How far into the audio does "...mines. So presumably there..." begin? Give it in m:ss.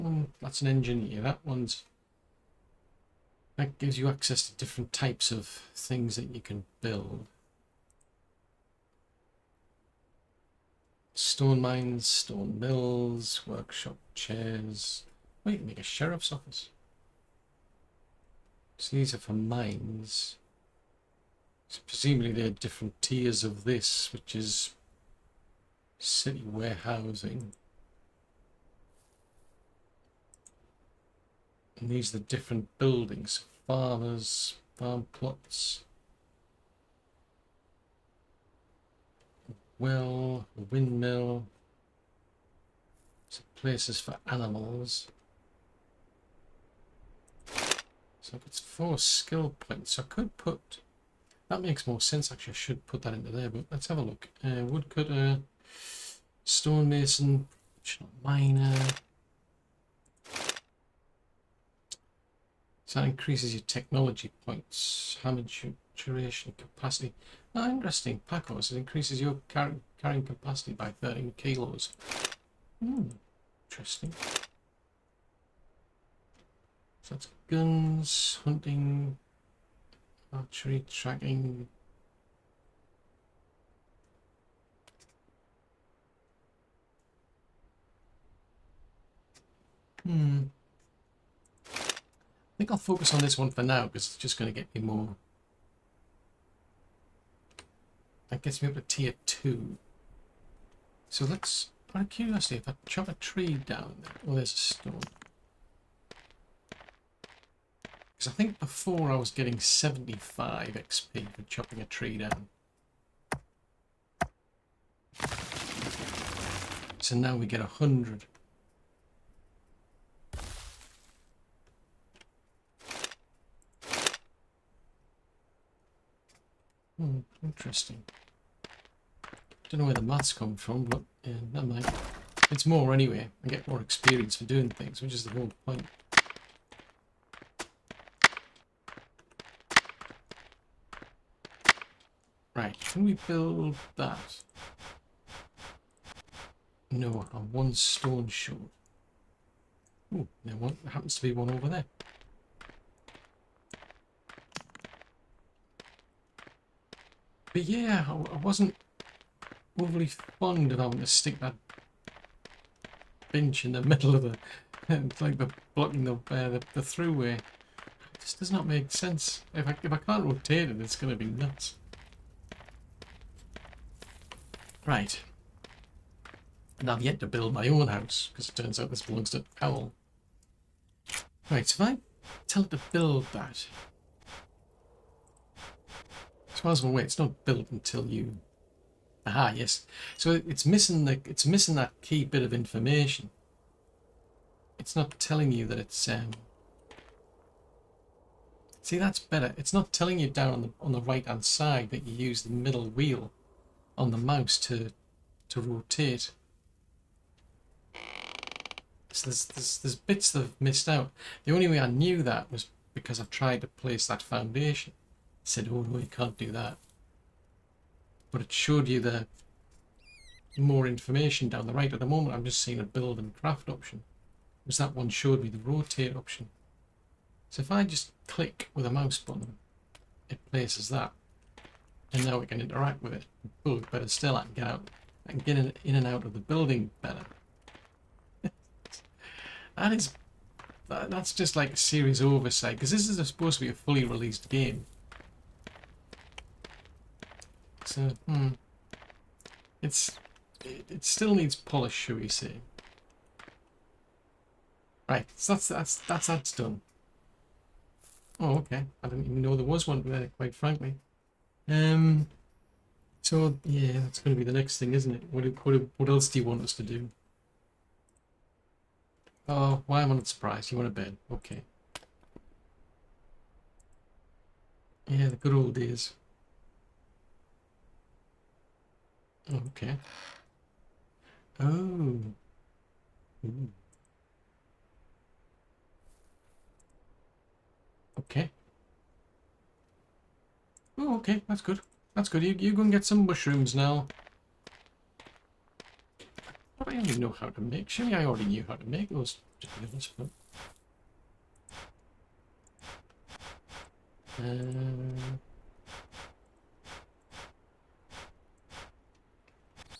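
0:19.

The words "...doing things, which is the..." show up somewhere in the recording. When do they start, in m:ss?
2:14.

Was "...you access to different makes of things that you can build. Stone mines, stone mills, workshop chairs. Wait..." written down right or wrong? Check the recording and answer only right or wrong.
wrong.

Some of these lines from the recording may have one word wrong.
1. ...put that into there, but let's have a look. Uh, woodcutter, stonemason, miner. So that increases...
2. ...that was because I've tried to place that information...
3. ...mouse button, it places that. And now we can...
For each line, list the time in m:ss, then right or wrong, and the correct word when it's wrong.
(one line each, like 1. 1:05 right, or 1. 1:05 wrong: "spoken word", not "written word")
1. 0:52 right
2. 3:32 wrong: "foundation", not "information"
3. 3:48 right.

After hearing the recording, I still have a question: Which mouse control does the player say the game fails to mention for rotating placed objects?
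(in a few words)
Middle wheel.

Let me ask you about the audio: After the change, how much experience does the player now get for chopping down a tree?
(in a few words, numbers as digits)
100.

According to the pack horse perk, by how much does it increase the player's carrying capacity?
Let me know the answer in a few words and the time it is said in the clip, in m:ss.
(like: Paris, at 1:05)
13 kilos, at 1:11.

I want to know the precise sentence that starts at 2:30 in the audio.
Oh, there one, happens to be one over there.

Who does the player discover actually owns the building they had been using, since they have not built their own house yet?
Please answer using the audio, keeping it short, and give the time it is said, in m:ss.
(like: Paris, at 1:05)
Owl, at 2:59.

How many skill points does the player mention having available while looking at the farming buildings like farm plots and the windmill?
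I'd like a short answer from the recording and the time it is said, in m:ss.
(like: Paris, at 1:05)
4, at 0:48.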